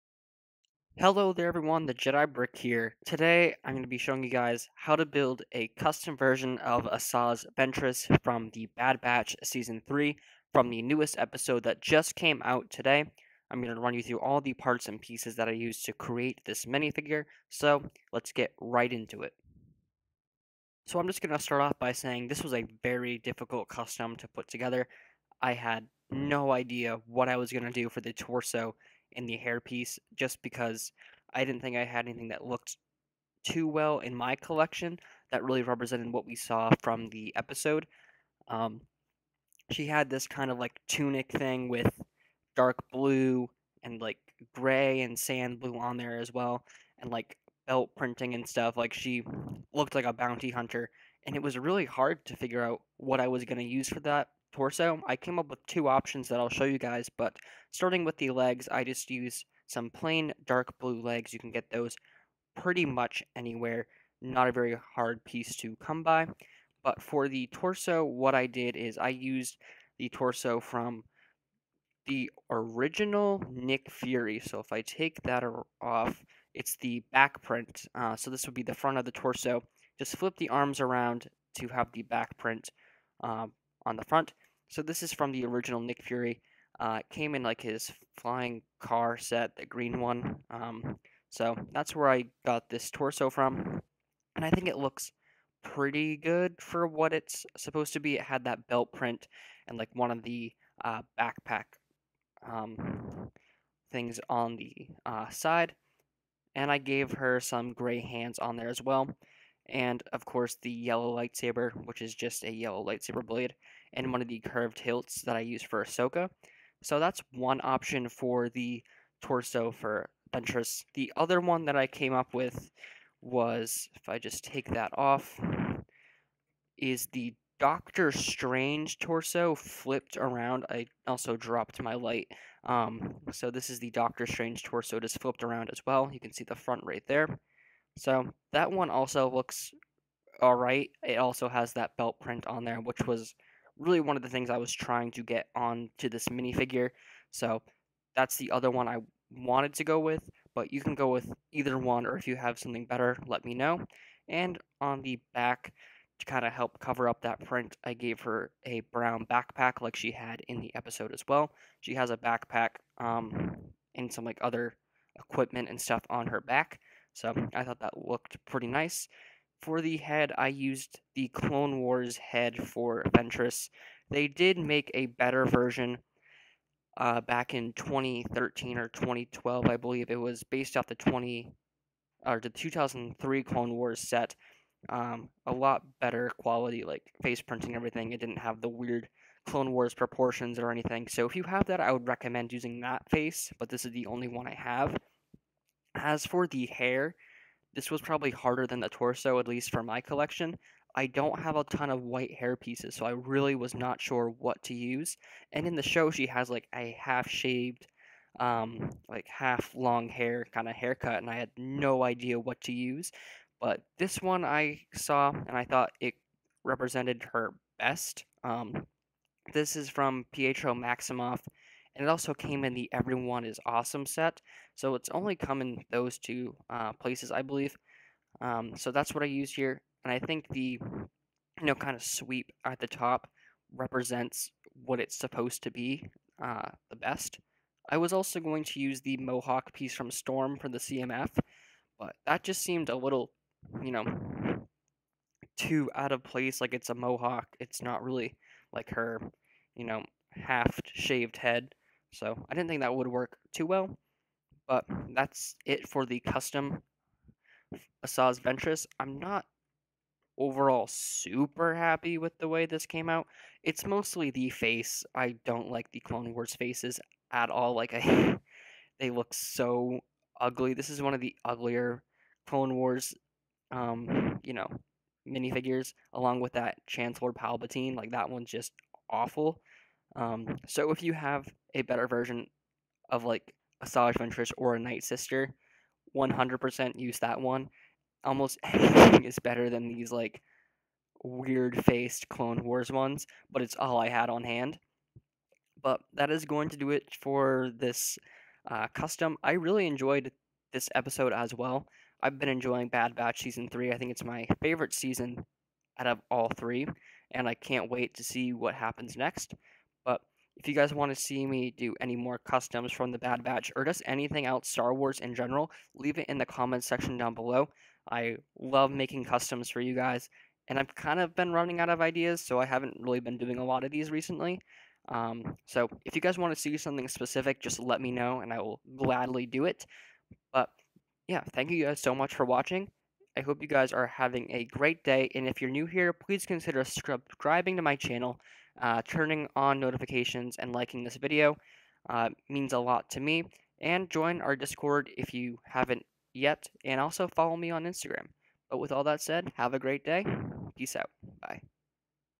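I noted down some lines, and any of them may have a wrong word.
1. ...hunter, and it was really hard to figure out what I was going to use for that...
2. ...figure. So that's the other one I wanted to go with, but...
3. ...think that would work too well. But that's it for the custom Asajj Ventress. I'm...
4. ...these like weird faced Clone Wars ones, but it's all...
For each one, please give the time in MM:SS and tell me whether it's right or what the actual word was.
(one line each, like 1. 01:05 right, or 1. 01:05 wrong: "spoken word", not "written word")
1. 00:50 right
2. 02:26 wrong: "minifigure", not "figure"
3. 04:12 right
4. 04:49 right.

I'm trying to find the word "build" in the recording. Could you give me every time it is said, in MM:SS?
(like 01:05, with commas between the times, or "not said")
00:05.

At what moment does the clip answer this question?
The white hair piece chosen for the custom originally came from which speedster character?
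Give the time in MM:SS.
03:40.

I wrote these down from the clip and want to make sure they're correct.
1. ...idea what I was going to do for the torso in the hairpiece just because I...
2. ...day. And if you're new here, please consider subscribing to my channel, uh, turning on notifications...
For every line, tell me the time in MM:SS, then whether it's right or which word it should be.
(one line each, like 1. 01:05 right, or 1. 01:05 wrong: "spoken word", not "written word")
1. 00:26 right
2. 05:35 right.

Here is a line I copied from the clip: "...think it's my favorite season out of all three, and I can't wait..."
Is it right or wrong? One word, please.
right.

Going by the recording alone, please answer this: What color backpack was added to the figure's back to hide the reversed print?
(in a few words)
Brown.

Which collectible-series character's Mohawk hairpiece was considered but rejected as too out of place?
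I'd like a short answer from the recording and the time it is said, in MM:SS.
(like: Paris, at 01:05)
Storm, at 04:00.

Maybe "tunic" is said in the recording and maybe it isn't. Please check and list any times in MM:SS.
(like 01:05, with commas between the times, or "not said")
00:40.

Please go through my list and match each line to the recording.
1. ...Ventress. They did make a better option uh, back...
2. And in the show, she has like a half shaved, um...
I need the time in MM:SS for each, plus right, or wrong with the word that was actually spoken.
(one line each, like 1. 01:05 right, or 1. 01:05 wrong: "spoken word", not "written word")
1. 02:53 wrong: "version", not "option"
2. 03:25 right.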